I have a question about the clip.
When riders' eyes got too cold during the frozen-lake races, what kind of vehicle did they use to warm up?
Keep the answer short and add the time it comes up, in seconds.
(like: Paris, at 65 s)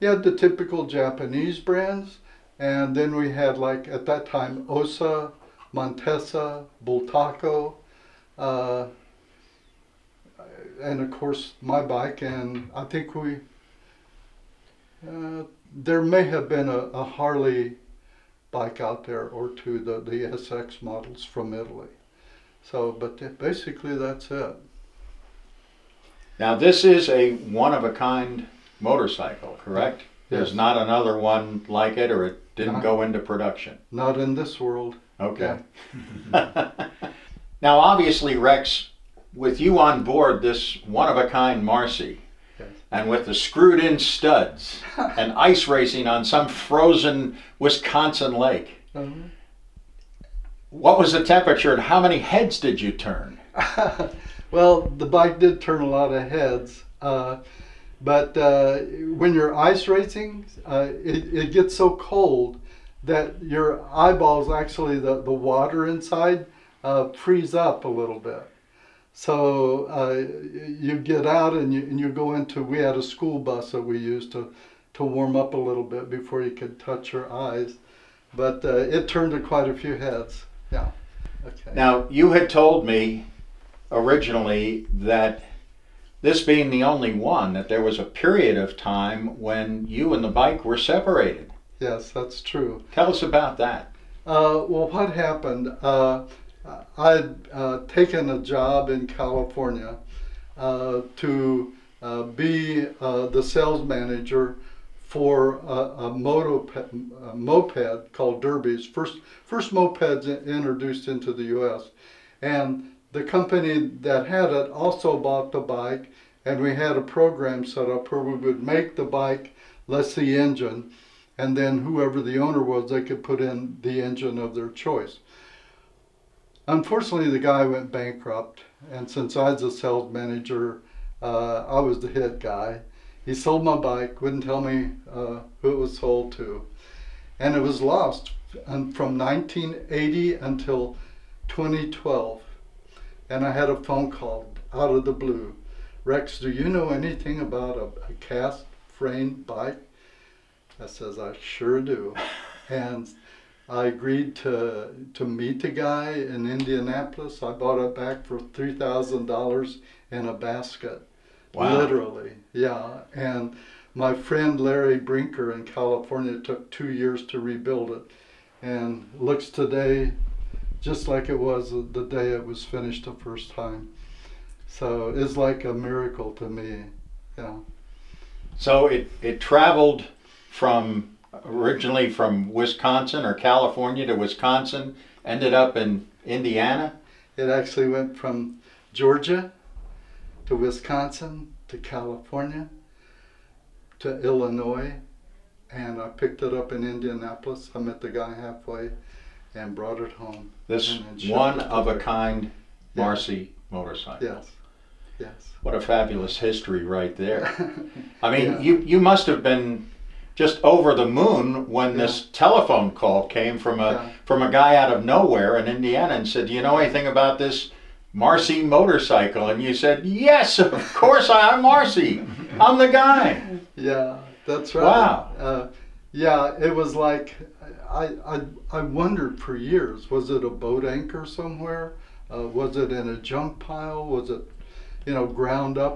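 A school bus, at 73 s.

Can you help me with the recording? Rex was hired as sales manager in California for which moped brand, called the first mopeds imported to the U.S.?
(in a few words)
Derbies.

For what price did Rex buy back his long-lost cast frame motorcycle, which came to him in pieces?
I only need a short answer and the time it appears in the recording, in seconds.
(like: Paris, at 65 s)
$3,000, at 158 s.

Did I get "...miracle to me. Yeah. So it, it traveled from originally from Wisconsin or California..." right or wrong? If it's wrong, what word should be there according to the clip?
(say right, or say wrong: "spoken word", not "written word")
right.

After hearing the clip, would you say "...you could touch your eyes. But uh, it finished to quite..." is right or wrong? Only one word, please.
wrong.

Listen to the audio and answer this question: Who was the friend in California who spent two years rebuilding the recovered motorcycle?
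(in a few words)
Larry Brinker.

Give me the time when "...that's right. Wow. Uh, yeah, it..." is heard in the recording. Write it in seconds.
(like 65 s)
224 s.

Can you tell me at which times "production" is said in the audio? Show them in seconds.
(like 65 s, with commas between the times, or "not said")
33 s.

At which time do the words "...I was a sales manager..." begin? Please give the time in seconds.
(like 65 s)
129 s.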